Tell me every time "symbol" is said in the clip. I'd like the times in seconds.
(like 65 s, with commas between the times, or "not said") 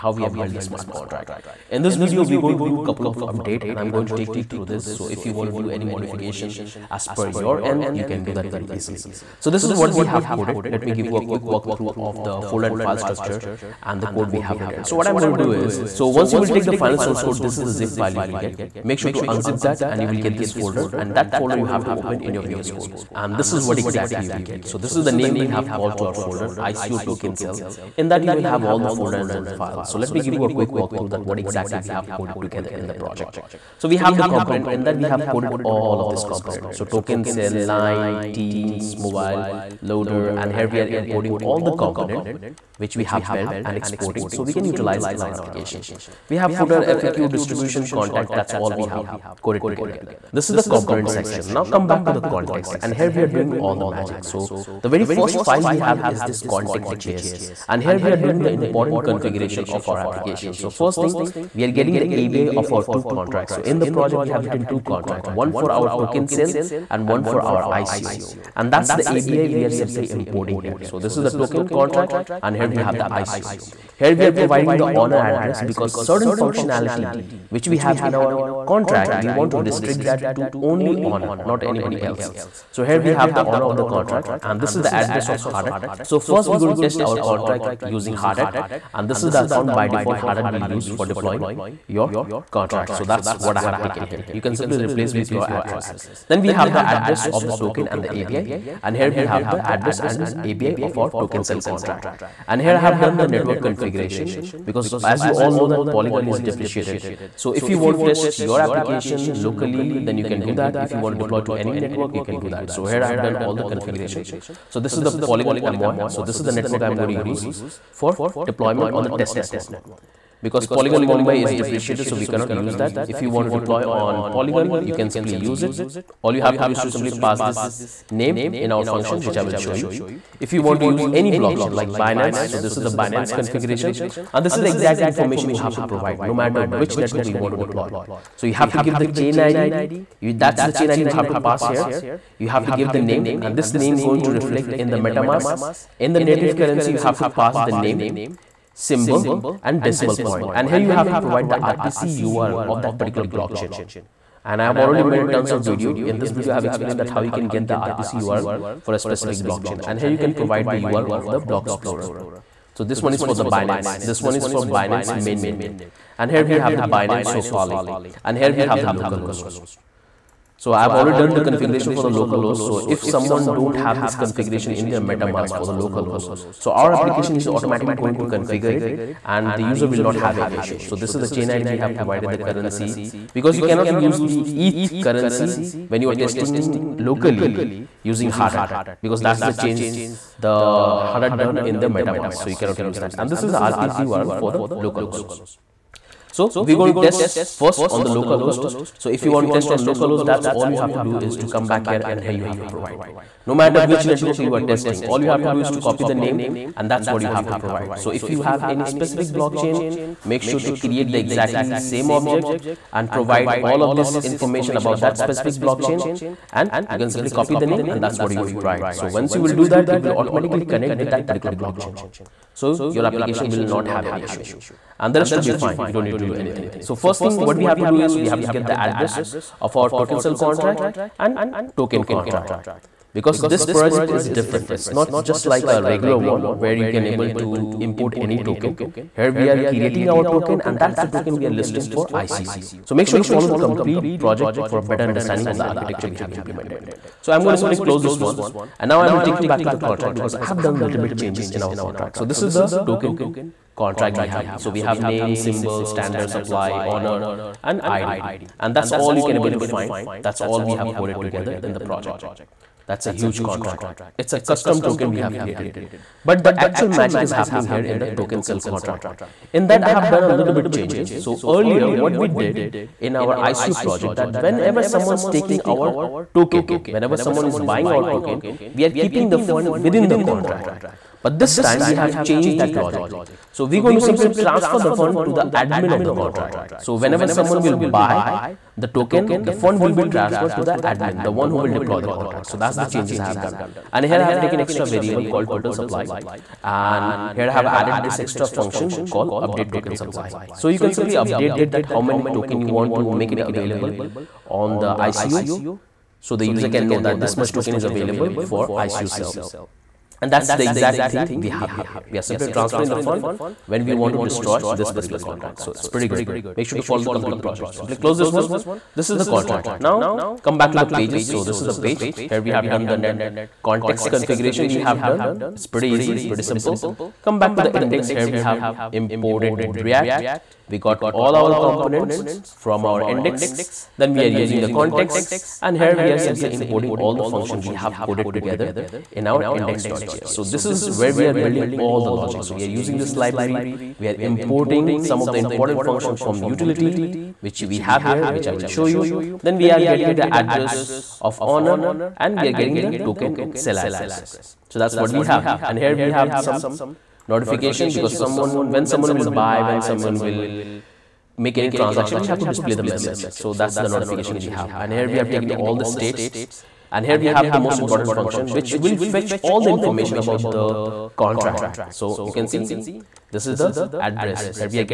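148 s, 255 s.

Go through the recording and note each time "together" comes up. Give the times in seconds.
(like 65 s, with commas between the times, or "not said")
32 s, 49 s, 261 s, 338 s.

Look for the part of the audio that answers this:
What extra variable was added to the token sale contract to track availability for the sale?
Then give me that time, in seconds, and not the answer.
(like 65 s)
295 s.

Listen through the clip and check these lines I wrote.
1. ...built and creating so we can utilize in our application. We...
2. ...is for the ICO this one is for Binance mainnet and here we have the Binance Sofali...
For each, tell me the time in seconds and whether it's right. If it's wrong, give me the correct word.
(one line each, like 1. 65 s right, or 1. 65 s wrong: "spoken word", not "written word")
1. 43 s wrong: "exporting", not "creating"
2. 163 s wrong: "Binance", not "ICO".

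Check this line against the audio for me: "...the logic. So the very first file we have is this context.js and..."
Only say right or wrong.
wrong.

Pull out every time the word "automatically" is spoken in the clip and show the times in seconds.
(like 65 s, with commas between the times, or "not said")
177 s, 220 s.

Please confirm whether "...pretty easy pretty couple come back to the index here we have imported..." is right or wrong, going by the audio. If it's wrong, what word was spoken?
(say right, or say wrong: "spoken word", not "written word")
wrong: "simple", not "couple".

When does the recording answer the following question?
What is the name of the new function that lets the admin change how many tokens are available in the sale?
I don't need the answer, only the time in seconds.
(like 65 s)
299 s.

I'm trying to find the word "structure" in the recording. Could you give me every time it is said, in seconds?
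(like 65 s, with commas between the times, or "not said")
12 s.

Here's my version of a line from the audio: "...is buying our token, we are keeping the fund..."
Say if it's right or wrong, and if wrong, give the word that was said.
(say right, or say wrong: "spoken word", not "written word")
right.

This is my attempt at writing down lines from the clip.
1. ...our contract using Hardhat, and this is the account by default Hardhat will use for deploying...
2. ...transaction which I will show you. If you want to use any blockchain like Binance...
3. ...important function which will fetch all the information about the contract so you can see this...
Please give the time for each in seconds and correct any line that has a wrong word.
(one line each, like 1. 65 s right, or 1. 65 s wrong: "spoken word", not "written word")
1. 86 s right
2. 128 s wrong: "function", not "transaction"
3. 367 s right.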